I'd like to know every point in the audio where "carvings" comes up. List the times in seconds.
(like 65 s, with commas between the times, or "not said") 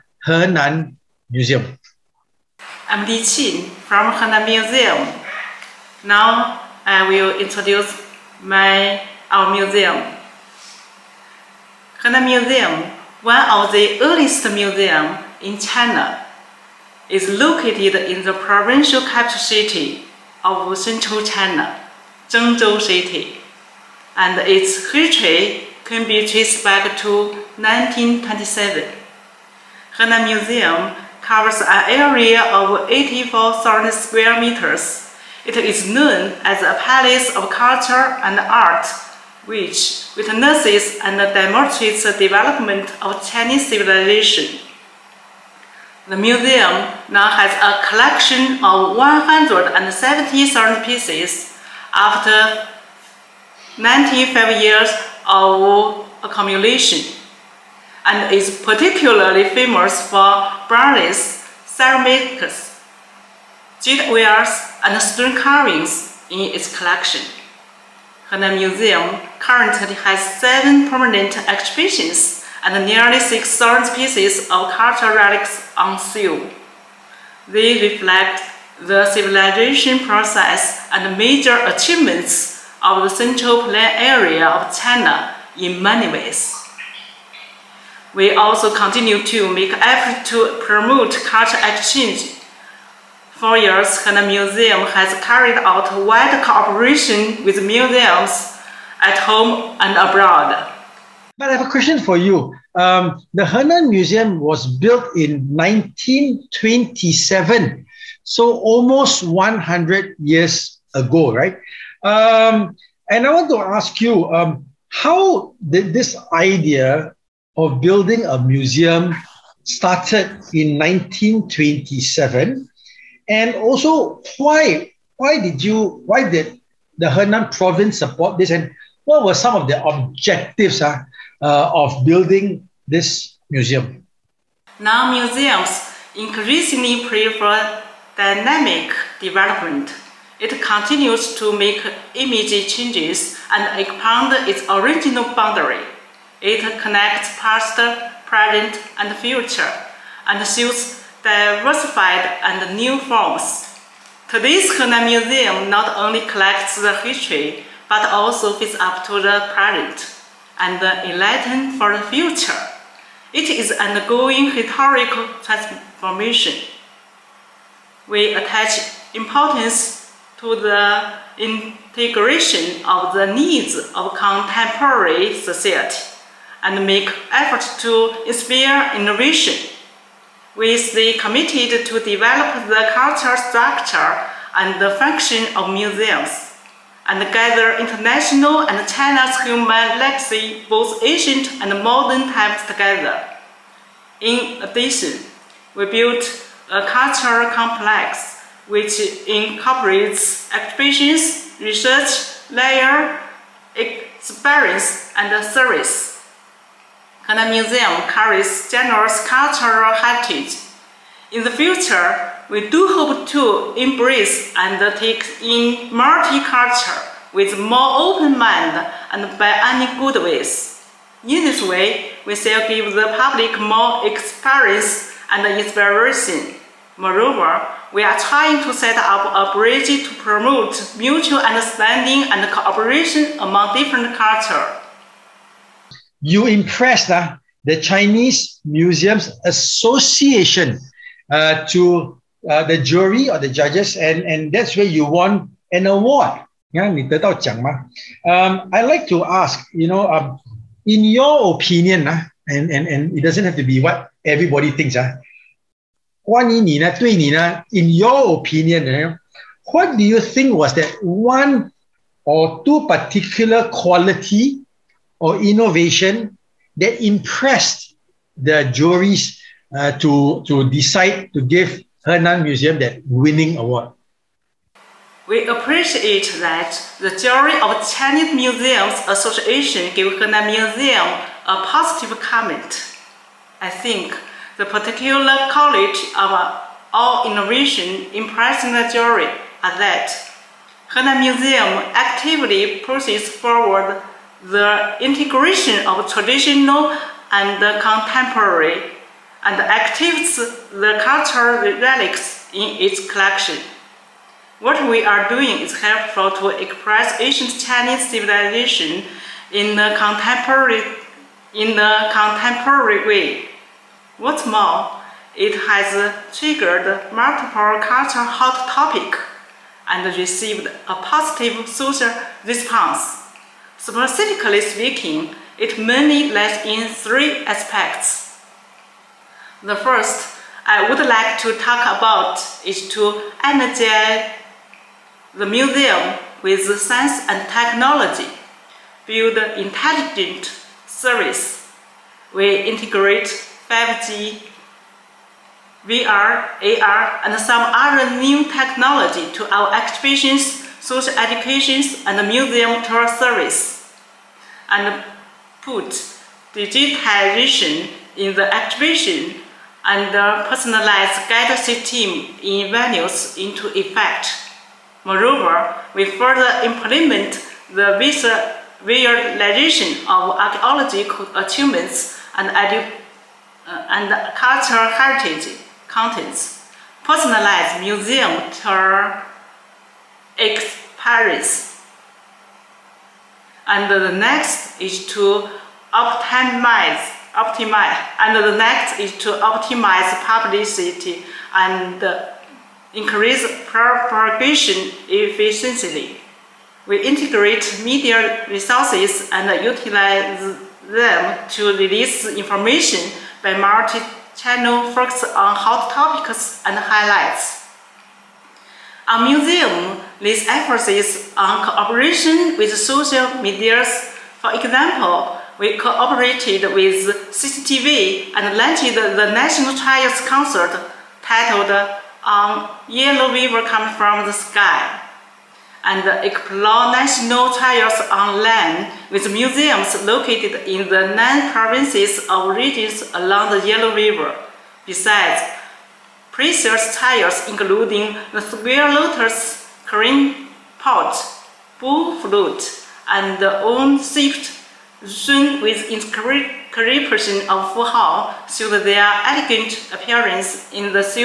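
65 s.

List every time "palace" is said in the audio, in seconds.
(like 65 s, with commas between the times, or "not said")
36 s.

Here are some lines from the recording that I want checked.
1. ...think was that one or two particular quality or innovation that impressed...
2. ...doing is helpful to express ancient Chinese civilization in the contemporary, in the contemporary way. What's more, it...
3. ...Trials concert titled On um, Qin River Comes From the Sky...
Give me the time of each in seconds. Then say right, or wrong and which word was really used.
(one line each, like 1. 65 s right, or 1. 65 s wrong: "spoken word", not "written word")
1. 260 s right
2. 305 s right
3. 419 s wrong: "Yellow", not "Qin".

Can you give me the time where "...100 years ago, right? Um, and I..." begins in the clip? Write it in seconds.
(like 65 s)
109 s.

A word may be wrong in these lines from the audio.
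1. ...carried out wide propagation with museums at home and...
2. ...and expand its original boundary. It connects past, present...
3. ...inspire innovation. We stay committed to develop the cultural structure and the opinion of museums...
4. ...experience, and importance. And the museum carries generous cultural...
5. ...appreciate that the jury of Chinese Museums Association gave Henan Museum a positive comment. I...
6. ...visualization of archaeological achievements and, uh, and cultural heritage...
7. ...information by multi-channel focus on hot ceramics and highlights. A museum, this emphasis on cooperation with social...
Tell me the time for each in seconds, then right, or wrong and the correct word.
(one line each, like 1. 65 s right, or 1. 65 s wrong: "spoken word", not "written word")
1. 95 s wrong: "cooperation", not "propagation"
2. 143 s right
3. 178 s wrong: "function", not "opinion"
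4. 203 s wrong: "service", not "importance"
5. 275 s right
6. 367 s right
7. 402 s wrong: "topics", not "ceramics".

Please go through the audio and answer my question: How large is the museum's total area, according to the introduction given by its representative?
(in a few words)
84,000 square meters.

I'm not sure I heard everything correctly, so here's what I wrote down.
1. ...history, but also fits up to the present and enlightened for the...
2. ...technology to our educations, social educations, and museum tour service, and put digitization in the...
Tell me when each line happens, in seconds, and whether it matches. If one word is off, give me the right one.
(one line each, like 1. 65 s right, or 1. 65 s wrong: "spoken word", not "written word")
1. 156 s right
2. 348 s wrong: "exhibitions", not "educations".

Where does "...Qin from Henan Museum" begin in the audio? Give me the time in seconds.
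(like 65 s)
3 s.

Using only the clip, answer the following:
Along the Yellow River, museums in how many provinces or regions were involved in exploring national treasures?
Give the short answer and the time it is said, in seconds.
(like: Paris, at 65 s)
9, at 431 s.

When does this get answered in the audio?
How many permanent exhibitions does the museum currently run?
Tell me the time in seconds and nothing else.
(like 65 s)
70 s.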